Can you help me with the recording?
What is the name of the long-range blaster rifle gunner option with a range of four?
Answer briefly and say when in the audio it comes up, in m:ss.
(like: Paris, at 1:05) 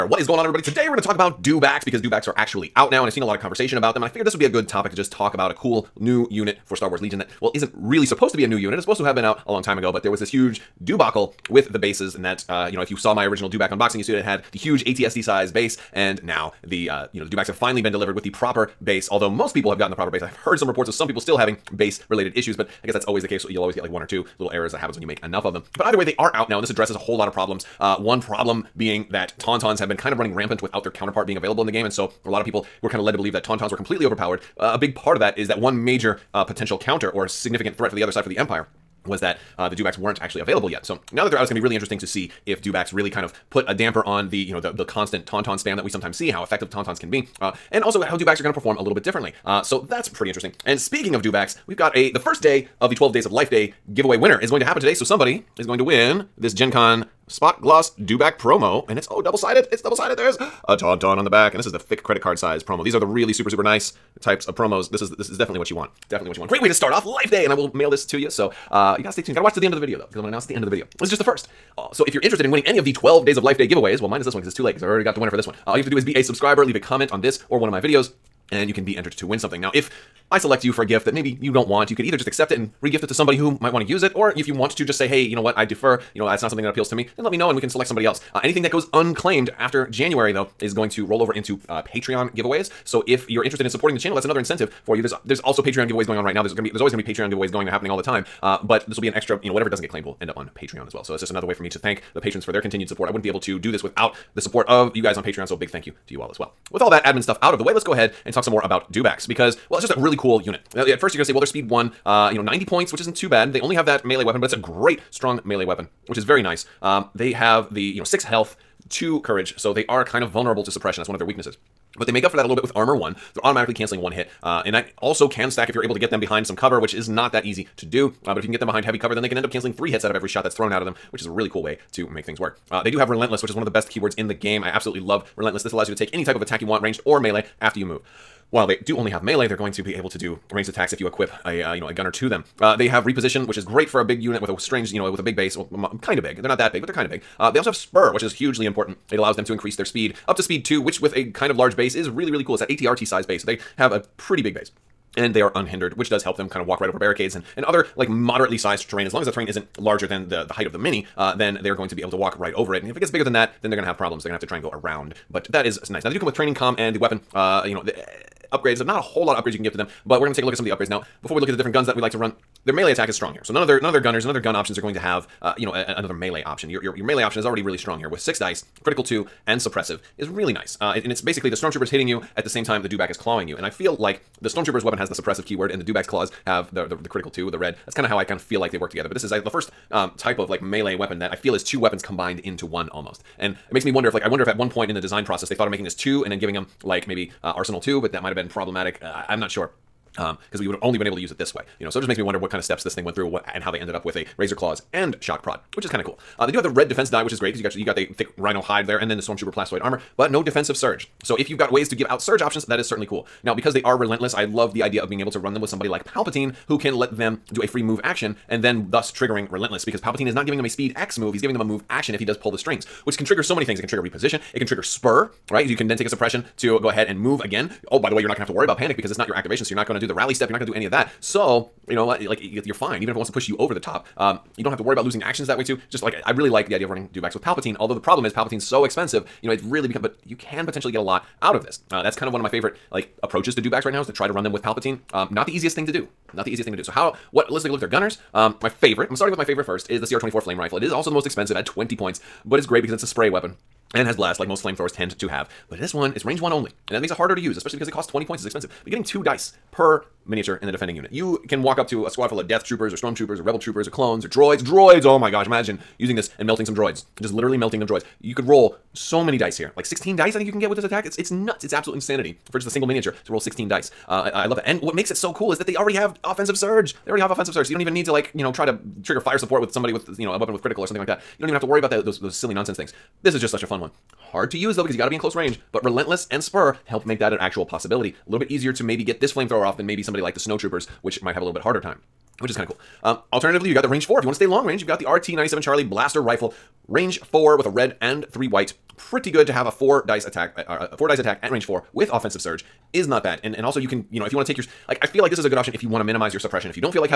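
RT-97 Charlie Blaster Rifle, at 4:55.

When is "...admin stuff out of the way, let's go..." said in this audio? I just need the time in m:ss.
1:47.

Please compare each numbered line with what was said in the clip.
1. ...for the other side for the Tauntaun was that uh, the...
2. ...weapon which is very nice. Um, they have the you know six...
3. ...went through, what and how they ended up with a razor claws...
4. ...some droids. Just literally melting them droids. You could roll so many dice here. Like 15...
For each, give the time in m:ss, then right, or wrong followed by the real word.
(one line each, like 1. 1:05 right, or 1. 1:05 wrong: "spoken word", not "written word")
1. 0:37 wrong: "Empire", not "Tauntaun"
2. 1:55 right
3. 3:23 right
4. 4:26 wrong: "16", not "15".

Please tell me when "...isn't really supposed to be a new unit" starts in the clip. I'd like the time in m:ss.
0:07.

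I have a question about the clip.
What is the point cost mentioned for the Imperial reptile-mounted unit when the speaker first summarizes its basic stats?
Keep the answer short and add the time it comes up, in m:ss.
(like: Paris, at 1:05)
90 points, at 1:52.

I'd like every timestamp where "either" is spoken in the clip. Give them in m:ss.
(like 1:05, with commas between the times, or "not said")
0:25, 1:22.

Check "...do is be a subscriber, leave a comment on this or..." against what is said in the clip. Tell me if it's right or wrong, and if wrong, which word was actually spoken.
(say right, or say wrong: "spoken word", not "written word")
right.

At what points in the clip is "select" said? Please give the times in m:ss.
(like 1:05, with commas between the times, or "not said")
1:20, 1:27.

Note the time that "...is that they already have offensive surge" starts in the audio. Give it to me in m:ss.
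4:35.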